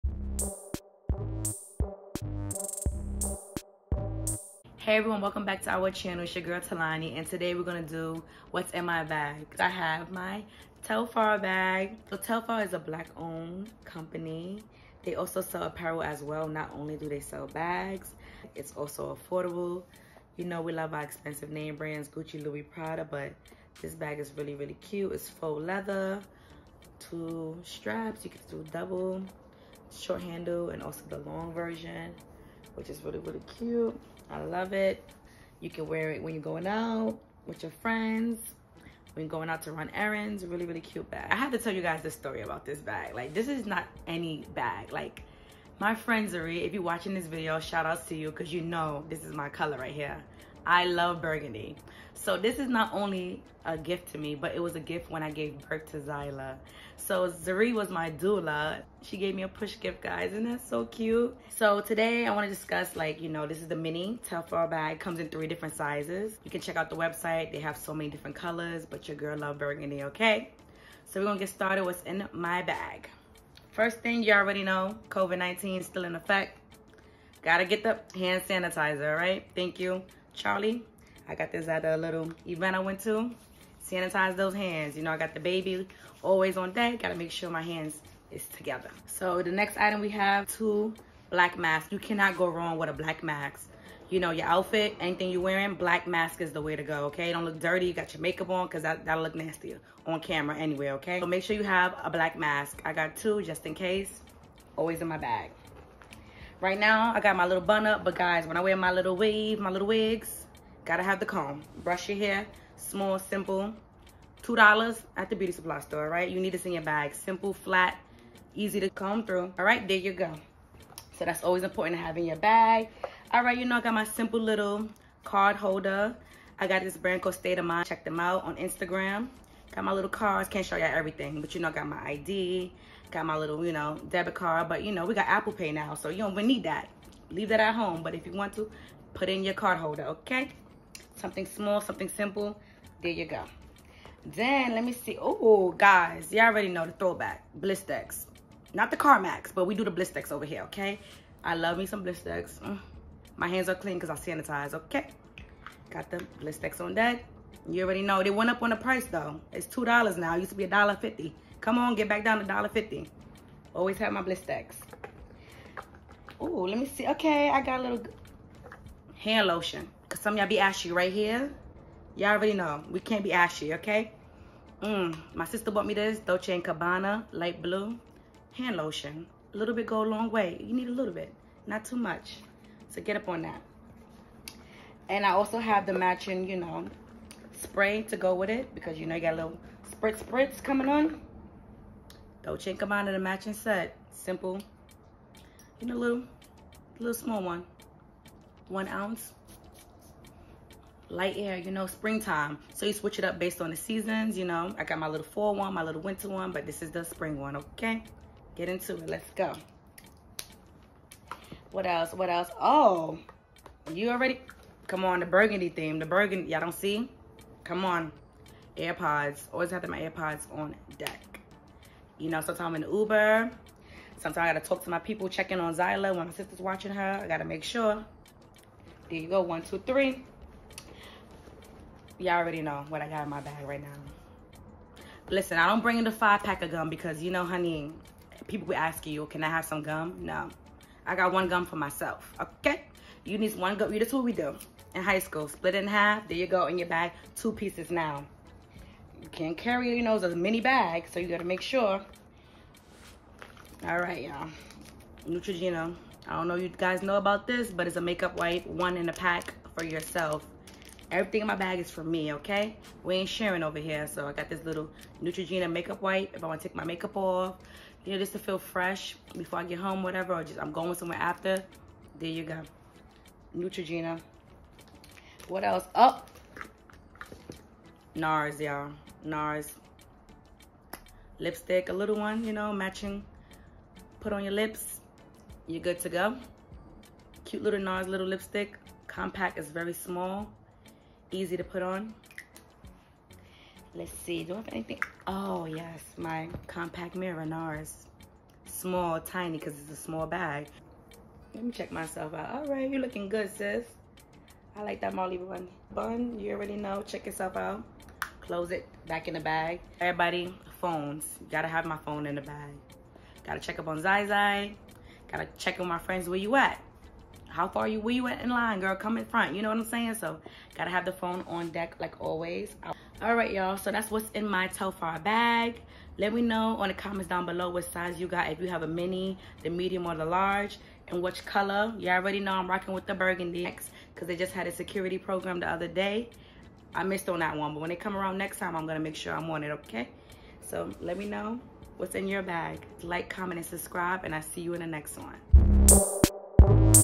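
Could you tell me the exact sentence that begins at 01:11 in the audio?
So we're going to get started what's in my bag.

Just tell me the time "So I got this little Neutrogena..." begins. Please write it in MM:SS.
04:24.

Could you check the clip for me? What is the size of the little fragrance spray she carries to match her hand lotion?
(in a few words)
1 ounce.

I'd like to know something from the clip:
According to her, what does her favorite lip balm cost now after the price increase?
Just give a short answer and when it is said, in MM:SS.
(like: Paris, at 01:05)
2 dollars, at 02:39.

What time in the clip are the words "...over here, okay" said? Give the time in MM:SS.
02:30.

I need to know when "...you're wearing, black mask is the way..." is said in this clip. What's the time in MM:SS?
01:35.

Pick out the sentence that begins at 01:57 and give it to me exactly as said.
Simple, flat, easy to comb through.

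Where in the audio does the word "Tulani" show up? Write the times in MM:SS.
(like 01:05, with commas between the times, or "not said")
00:06.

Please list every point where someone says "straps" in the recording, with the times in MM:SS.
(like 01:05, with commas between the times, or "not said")
00:27.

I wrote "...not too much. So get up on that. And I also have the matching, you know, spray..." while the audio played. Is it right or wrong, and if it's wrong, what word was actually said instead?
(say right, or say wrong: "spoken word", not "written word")
right.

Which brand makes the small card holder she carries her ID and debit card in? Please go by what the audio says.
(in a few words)
State of Mind.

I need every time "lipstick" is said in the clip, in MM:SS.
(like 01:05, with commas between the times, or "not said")
04:41, 04:48.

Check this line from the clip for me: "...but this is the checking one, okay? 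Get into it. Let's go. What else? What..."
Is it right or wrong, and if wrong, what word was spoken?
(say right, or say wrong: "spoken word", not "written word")
wrong: "spring", not "checking".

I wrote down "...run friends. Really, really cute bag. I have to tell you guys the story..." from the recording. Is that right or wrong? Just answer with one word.
wrong.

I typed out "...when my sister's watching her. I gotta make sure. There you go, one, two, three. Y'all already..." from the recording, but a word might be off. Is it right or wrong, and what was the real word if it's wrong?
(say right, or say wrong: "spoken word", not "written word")
right.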